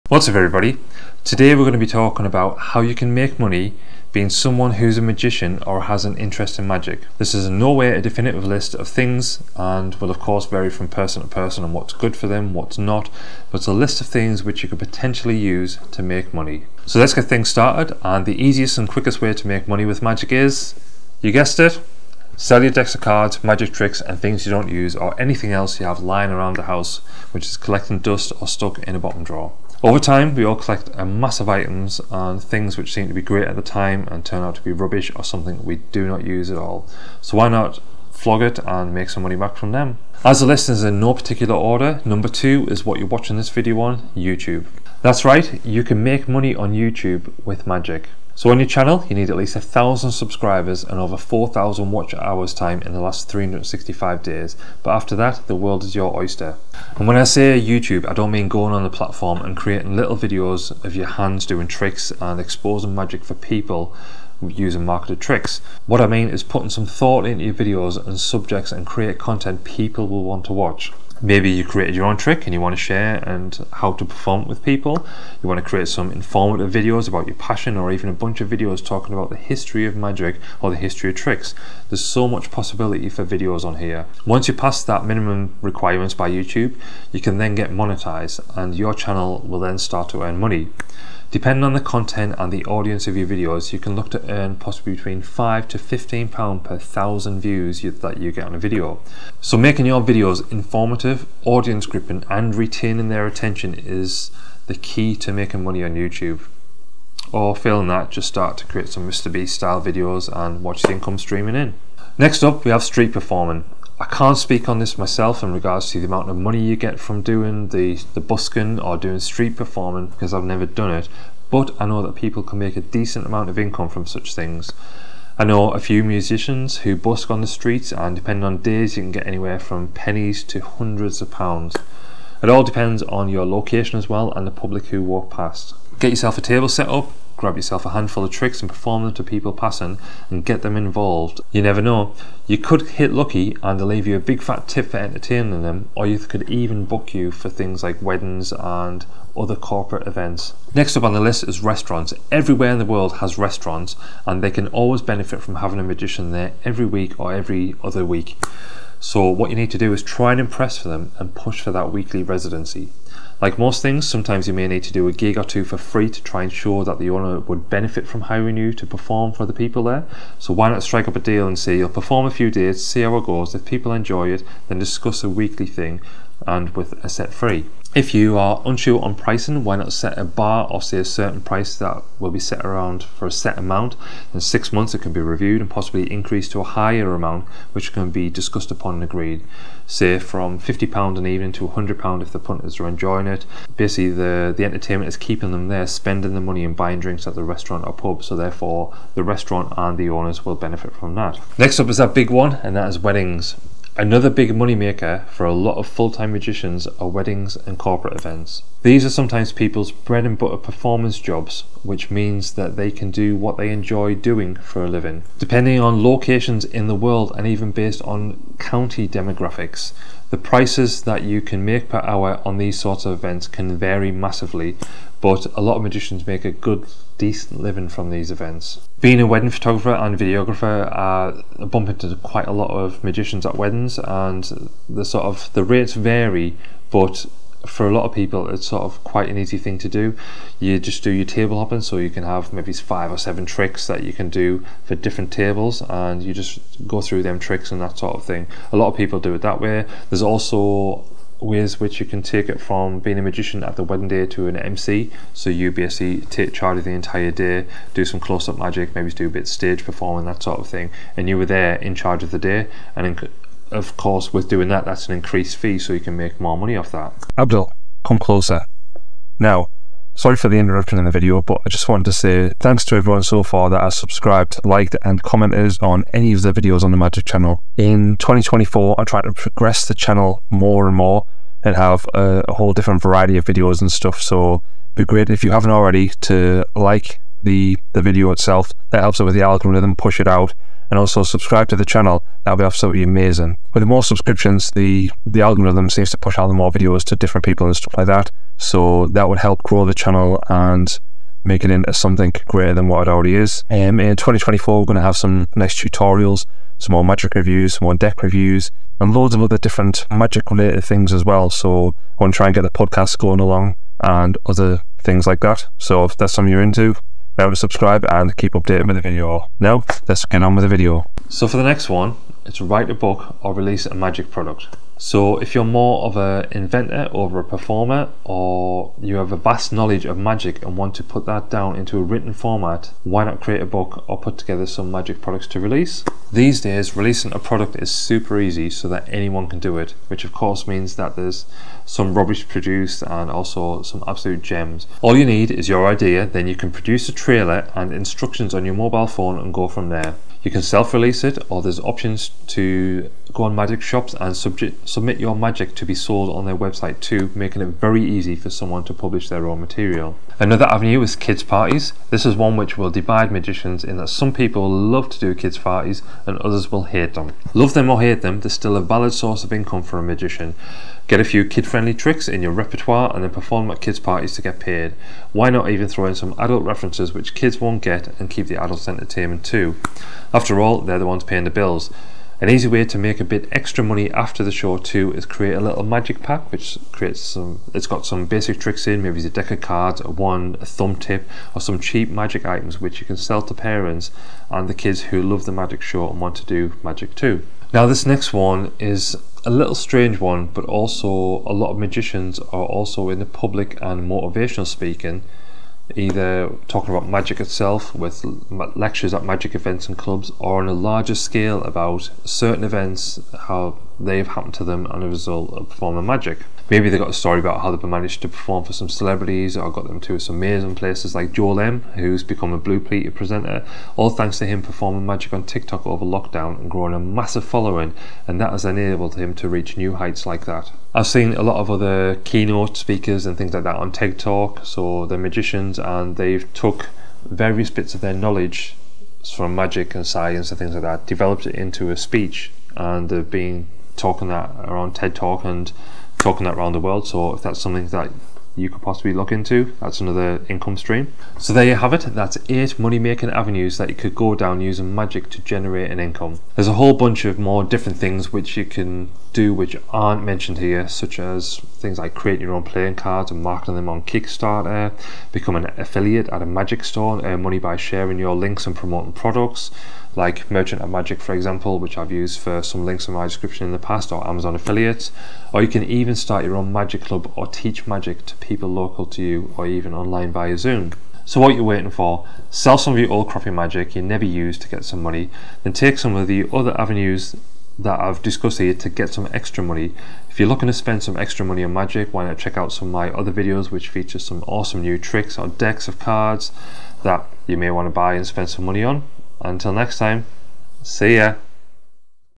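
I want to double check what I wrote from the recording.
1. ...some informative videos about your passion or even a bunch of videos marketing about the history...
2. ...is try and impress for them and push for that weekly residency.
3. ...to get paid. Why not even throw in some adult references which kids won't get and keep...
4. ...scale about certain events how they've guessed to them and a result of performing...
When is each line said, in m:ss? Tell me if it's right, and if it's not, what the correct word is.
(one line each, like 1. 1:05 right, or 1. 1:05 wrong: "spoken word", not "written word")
1. 1:15 wrong: "talking", not "marketing"
2. 2:39 right
3. 6:14 right
4. 6:51 wrong: "happened", not "guessed".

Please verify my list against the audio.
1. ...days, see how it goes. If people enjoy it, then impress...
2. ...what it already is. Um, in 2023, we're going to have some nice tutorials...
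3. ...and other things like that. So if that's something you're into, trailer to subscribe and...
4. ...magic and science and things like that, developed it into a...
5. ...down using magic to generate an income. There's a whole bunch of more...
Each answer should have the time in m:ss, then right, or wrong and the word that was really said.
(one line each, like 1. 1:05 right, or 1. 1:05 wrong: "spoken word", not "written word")
1. 2:52 wrong: "discuss", not "impress"
2. 5:02 wrong: "2024", not "2023"
3. 5:14 wrong: "remember", not "trailer"
4. 7:19 right
5. 7:34 right.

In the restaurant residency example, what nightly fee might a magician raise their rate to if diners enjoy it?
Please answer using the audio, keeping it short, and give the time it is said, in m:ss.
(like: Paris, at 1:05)
£100, at 3:11.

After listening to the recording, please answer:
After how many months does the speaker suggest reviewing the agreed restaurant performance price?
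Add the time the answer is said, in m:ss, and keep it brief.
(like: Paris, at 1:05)
6, at 3:04.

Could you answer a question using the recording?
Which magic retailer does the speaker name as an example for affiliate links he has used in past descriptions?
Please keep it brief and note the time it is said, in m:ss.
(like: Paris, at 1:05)
Merchant of Magic, at 7:50.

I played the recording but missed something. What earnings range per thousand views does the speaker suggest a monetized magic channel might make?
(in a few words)
5 to 15 pounds.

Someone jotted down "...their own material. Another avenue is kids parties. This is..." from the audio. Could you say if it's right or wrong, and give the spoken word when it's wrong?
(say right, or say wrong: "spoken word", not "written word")
right.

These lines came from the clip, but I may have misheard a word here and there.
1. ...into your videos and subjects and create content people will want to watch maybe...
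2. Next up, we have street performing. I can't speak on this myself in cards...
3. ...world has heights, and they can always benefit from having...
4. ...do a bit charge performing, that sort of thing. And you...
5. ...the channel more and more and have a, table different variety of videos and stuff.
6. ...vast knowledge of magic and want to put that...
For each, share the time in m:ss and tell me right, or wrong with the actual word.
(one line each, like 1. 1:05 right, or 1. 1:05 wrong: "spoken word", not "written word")
1. 1:07 right
2. 1:52 wrong: "regards", not "cards"
3. 2:32 wrong: "restaurants", not "heights"
4. 4:19 wrong: "stage", not "charge"
5. 4:39 wrong: "whole", not "table"
6. 5:29 right.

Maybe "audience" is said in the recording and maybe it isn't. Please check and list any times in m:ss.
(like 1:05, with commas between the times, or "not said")
1:32, 1:41.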